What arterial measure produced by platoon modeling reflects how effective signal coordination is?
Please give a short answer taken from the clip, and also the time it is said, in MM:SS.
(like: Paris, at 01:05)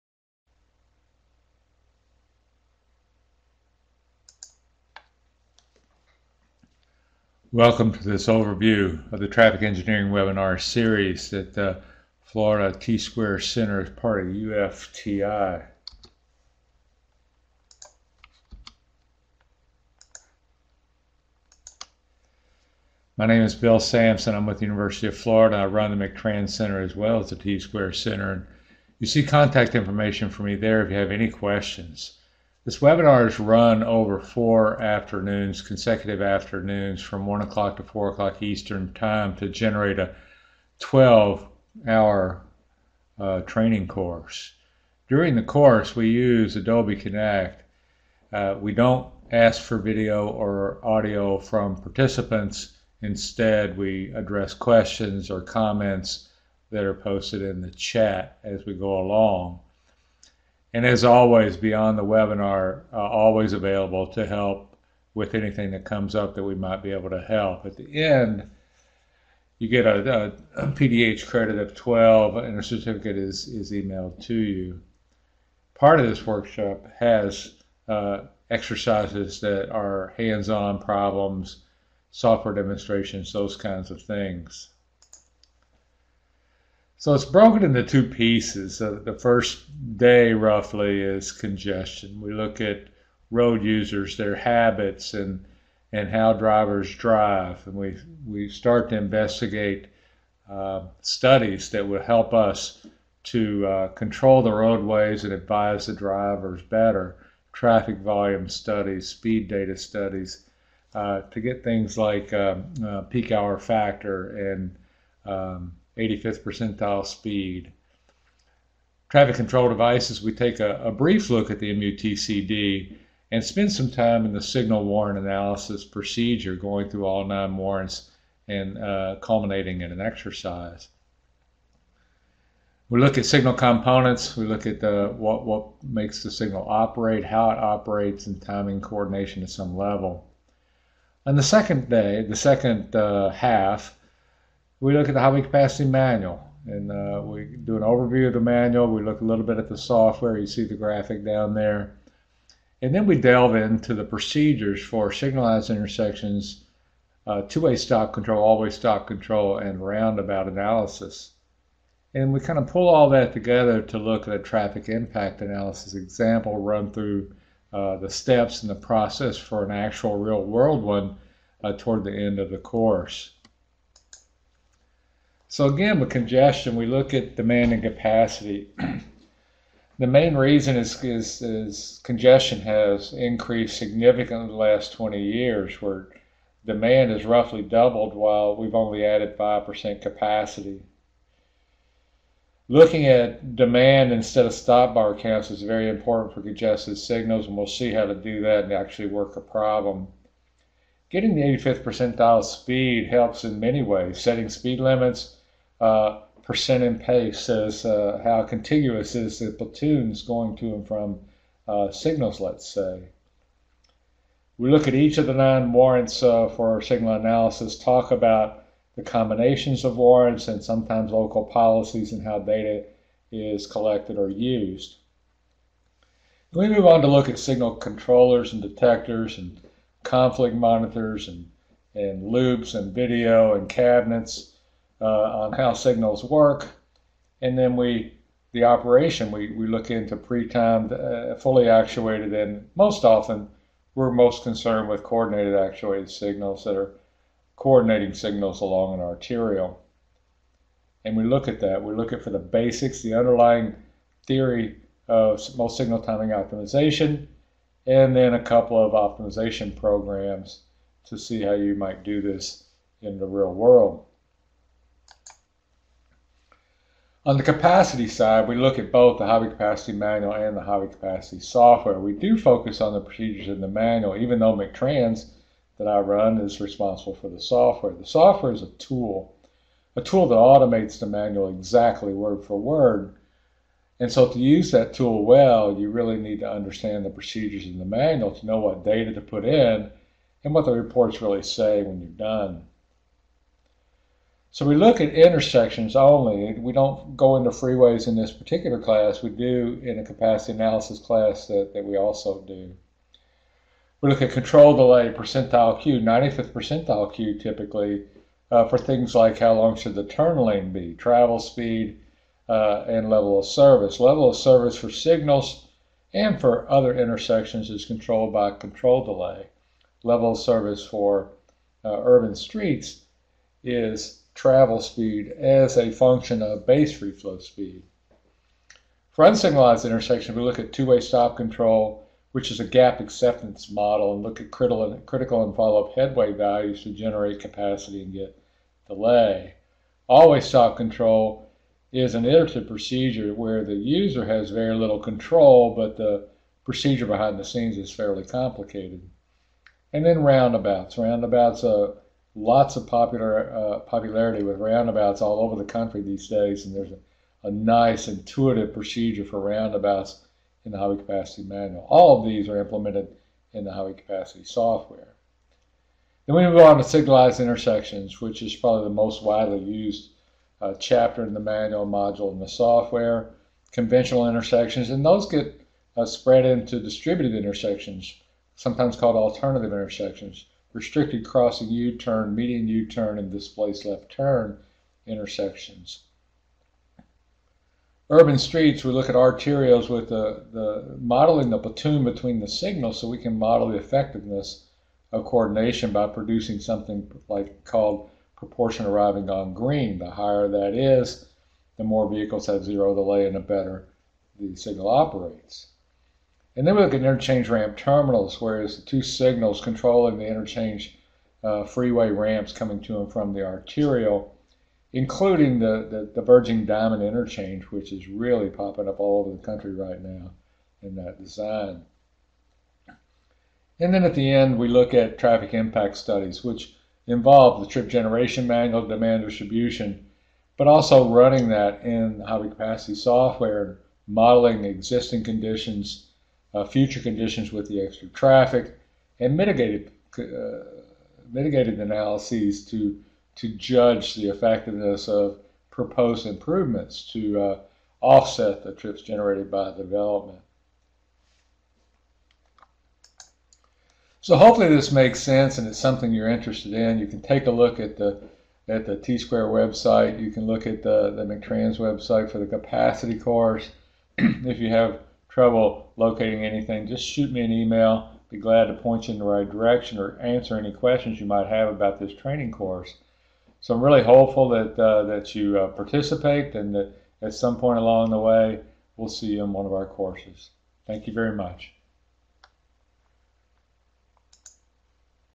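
proportion arriving on green, at 06:38.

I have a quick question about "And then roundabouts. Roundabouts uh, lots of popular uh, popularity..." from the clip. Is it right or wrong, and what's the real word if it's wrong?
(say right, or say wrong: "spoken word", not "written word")
right.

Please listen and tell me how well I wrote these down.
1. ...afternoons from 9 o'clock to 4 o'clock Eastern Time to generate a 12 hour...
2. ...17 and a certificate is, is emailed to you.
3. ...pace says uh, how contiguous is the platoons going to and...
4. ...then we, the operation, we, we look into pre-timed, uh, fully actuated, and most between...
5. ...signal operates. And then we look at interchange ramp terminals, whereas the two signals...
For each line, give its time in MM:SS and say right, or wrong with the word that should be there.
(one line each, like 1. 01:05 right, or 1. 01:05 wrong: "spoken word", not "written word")
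1. 00:36 wrong: "1", not "9"
2. 01:11 wrong: "12", not "17"
3. 03:26 right
4. 03:57 wrong: "often", not "between"
5. 06:44 right.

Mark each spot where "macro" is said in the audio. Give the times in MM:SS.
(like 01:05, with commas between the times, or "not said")
not said.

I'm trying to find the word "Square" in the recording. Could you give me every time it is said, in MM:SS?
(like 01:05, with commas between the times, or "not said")
00:12, 00:27, 07:38.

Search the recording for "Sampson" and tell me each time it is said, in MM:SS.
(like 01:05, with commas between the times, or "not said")
00:23.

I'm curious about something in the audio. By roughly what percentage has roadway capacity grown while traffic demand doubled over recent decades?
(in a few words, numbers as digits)
5%.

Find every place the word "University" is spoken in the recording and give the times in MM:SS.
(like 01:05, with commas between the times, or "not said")
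00:24.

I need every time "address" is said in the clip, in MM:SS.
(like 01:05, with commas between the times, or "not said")
00:54.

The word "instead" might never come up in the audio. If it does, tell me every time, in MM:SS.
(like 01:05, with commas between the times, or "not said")
00:53, 03:14.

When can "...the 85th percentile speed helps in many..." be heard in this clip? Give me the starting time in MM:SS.
03:21.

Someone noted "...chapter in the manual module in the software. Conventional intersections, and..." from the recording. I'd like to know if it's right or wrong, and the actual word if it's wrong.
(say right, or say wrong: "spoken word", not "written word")
right.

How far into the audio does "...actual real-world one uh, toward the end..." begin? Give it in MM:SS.
02:49.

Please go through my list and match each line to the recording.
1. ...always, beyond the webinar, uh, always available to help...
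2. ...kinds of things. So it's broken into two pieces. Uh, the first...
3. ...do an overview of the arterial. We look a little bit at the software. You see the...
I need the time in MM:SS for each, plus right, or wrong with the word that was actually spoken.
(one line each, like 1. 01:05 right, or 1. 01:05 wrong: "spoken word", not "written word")
1. 01:01 right
2. 01:23 right
3. 02:27 wrong: "manual", not "arterial".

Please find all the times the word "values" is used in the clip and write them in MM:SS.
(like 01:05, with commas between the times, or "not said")
05:36.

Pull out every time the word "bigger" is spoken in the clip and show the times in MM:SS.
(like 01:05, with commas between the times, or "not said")
not said.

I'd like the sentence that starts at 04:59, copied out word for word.
We do in a capacity analysis class that, that we also do.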